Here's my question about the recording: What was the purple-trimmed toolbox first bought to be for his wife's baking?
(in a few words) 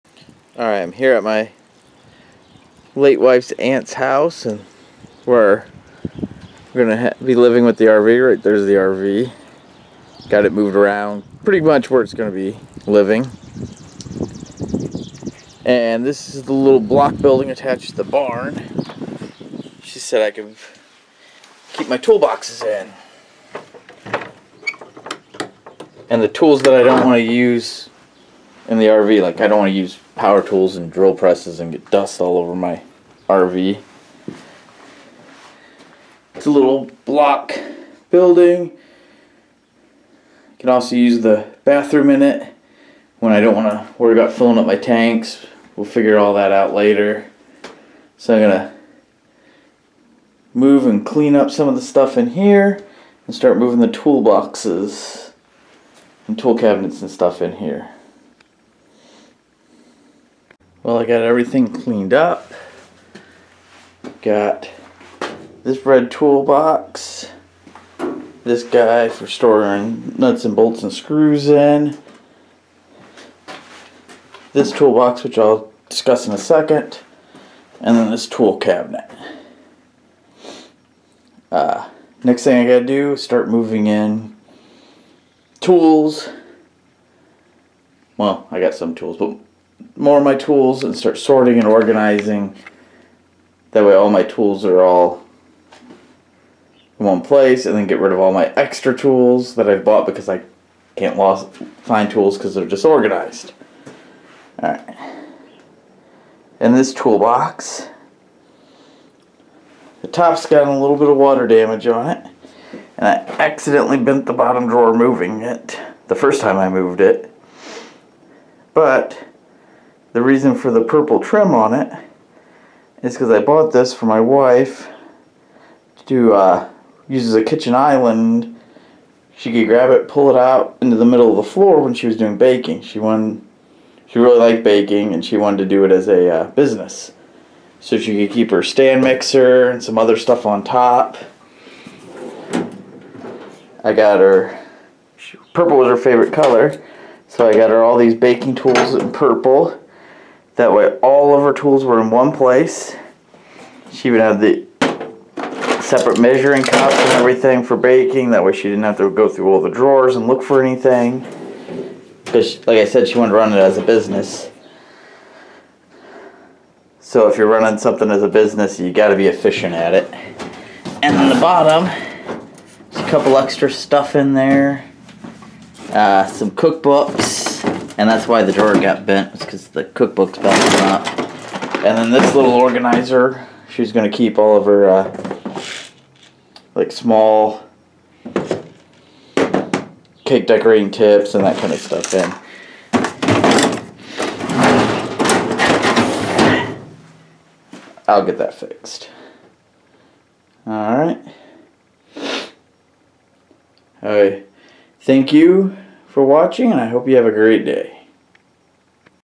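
Kitchen island.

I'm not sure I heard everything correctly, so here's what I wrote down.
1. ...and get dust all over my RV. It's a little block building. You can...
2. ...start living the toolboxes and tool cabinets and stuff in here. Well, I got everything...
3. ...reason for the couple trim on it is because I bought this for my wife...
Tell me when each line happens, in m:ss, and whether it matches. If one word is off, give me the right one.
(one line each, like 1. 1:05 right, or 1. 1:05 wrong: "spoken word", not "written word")
1. 0:31 right
2. 0:53 wrong: "moving", not "living"
3. 2:00 wrong: "purple", not "couple".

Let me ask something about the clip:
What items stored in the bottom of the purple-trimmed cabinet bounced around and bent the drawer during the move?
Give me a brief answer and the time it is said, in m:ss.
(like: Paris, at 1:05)
Cookbooks, at 2:59.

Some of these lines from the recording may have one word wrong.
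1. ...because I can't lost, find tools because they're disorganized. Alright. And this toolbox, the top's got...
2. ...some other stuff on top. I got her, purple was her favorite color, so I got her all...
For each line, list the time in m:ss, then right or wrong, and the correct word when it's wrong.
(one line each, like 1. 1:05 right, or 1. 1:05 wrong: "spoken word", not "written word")
1. 1:40 right
2. 2:19 right.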